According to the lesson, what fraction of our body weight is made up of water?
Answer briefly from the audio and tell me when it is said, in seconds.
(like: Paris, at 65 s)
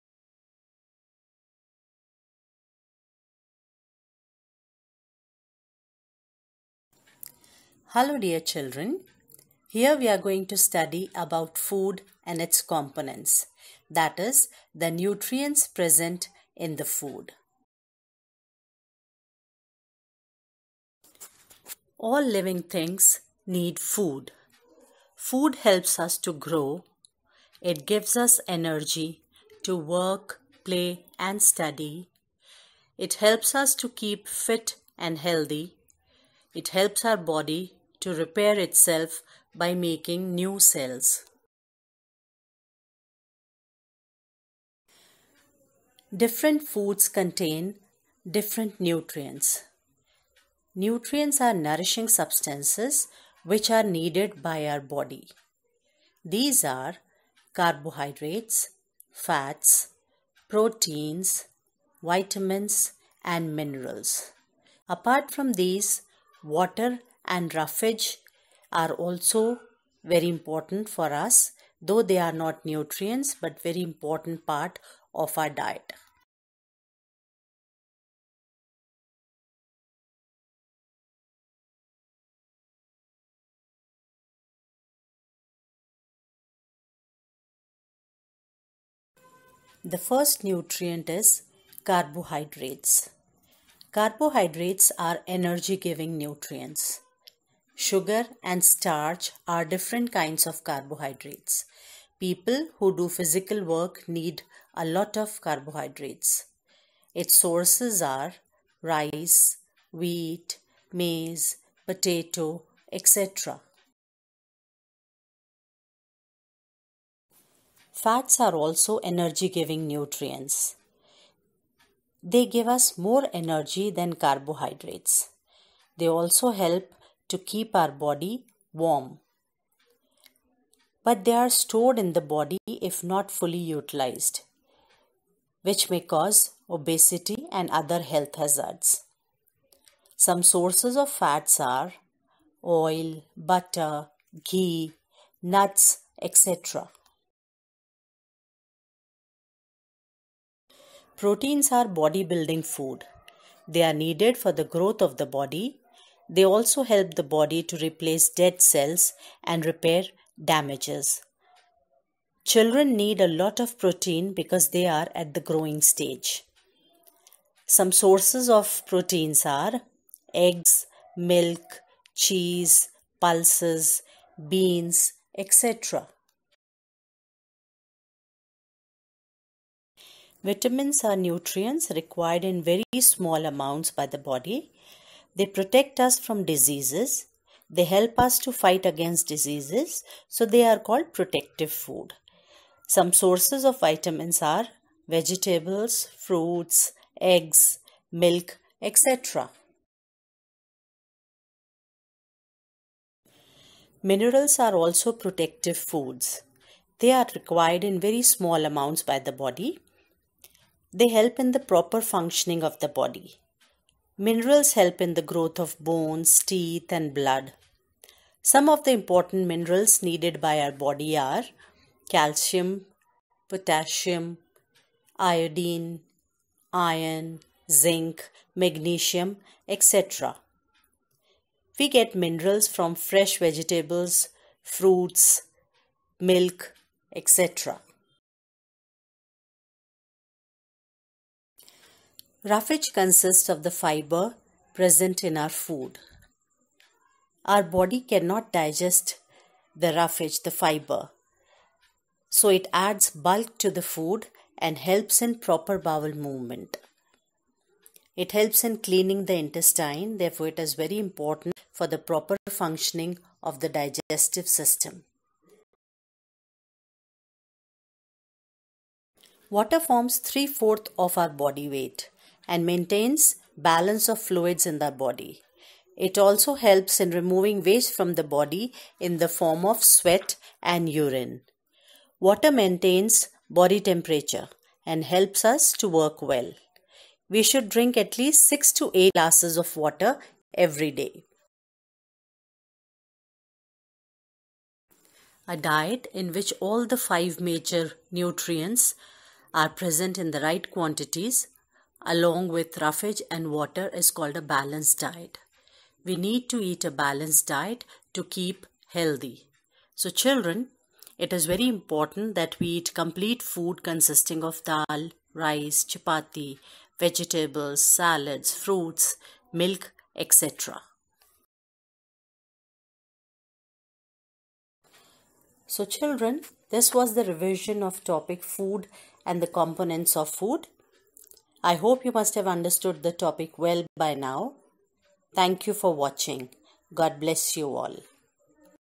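3/4, at 270 s.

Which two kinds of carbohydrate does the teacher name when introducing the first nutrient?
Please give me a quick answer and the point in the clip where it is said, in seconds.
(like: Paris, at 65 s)
Sugar and starch, at 97 s.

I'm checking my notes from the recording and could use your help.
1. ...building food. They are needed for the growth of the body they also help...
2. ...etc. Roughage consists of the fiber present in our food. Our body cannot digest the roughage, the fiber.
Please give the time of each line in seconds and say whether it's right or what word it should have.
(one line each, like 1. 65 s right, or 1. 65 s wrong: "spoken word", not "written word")
1. 152 s right
2. 237 s right.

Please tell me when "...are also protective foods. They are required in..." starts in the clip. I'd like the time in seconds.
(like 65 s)
204 s.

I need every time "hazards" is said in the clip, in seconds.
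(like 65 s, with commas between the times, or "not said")
138 s.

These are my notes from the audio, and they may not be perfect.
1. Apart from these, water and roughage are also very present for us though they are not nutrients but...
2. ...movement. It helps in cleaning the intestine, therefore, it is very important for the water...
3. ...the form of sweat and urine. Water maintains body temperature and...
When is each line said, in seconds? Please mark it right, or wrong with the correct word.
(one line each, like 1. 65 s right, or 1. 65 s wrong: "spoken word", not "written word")
1. 64 s wrong: "important", not "present"
2. 256 s wrong: "proper", not "water"
3. 279 s right.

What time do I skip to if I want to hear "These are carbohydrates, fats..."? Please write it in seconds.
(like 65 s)
56 s.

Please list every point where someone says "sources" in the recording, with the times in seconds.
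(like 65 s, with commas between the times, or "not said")
107 s, 140 s, 167 s, 193 s.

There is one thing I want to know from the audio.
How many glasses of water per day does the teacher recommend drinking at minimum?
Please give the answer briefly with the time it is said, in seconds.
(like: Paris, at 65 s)
6 to 8, at 288 s.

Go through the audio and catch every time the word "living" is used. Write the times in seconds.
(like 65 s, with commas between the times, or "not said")
22 s.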